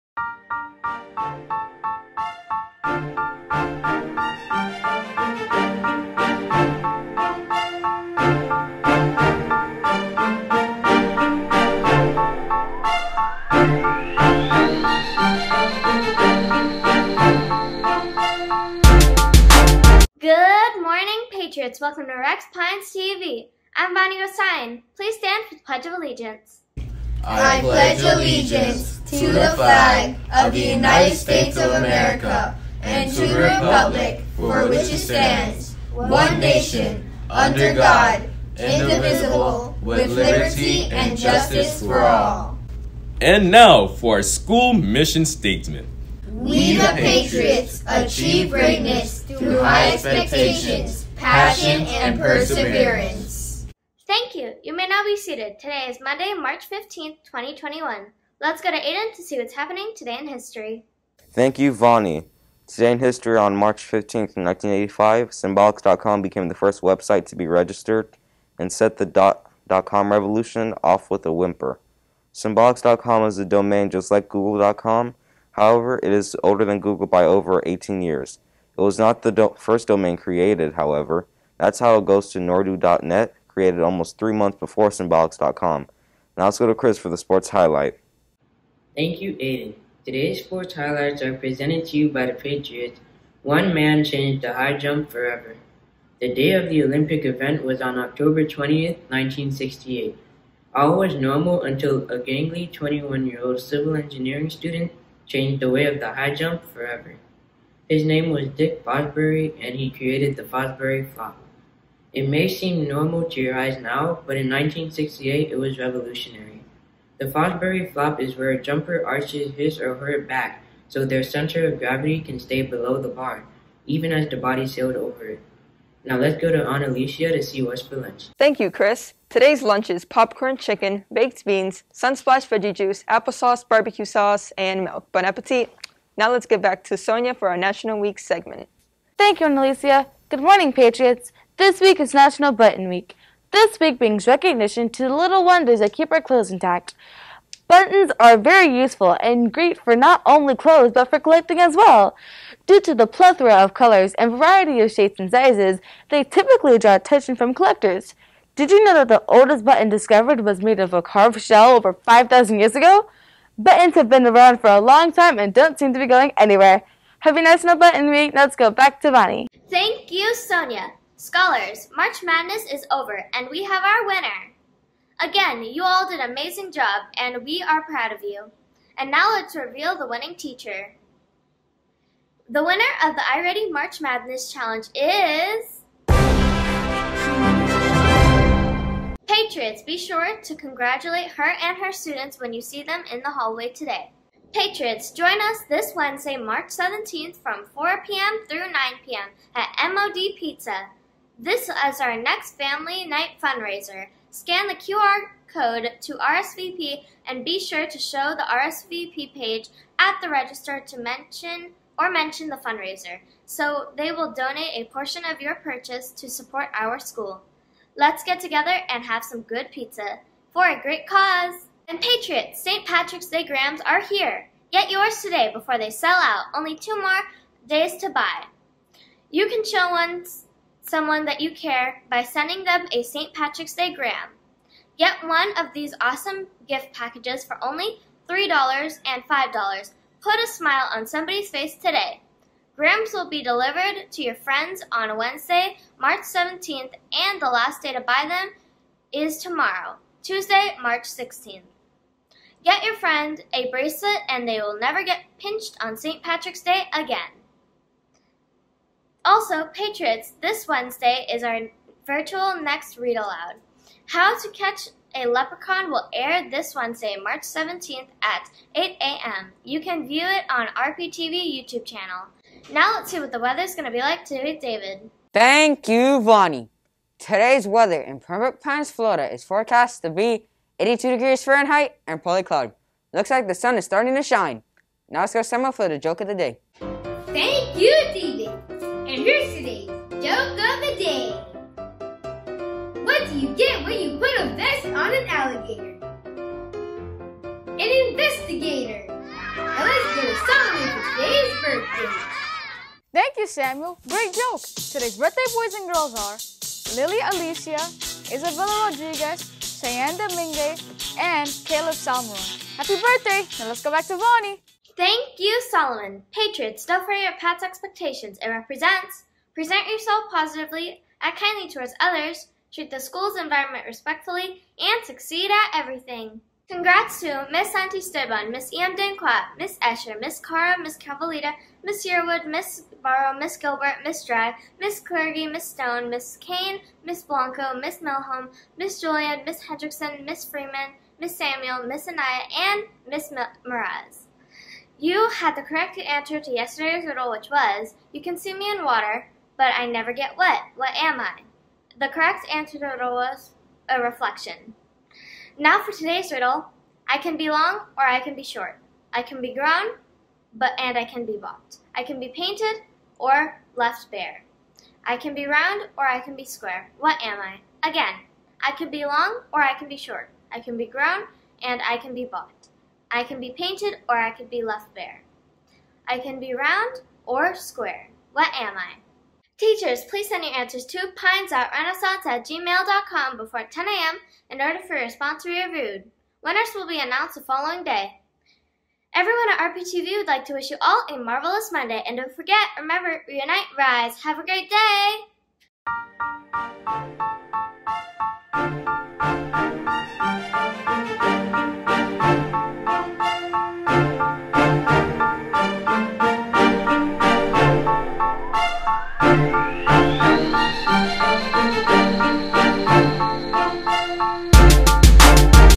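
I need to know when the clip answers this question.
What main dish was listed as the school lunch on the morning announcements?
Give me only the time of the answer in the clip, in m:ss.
2:10.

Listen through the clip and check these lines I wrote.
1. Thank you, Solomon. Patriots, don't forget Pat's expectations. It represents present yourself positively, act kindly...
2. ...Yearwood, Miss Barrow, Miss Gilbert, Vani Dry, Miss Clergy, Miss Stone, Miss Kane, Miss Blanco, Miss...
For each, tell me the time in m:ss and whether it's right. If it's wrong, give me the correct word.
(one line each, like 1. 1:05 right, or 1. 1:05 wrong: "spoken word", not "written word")
1. 5:14 right
2. 5:32 wrong: "Miss", not "Vani".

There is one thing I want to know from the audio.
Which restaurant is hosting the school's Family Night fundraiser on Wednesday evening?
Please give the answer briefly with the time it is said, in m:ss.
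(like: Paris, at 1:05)
MOD Pizza, at 3:19.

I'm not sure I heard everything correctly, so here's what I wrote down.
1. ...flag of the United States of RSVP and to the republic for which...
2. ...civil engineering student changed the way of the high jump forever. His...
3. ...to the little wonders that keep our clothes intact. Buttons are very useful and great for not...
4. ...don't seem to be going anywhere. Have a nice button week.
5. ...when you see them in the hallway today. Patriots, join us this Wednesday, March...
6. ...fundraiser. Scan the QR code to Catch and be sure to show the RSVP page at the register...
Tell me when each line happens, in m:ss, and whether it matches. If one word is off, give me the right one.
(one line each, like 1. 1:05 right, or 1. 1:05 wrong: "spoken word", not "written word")
1. 0:29 wrong: "America", not "RSVP"
2. 1:43 right
3. 2:24 right
4. 2:45 right
5. 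3:12 right
6. 3:23 wrong: "RSVP", not "Catch".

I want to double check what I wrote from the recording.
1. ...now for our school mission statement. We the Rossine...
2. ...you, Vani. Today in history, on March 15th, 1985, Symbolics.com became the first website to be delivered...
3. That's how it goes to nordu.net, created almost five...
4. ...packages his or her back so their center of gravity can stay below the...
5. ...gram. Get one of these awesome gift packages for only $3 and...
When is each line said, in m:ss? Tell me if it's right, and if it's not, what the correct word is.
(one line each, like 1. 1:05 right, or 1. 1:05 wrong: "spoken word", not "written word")
1. 0:43 wrong: "Patriots", not "Rossine"
2. 1:01 wrong: "registered", not "delivered"
3. 1:21 wrong: "three", not "five"
4. 1:59 wrong: "arches", not "packages"
5. 3:53 right.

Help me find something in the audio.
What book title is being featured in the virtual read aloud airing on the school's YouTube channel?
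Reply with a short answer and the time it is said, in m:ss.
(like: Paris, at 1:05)
How to Catch a Leprechaun, at 4:24.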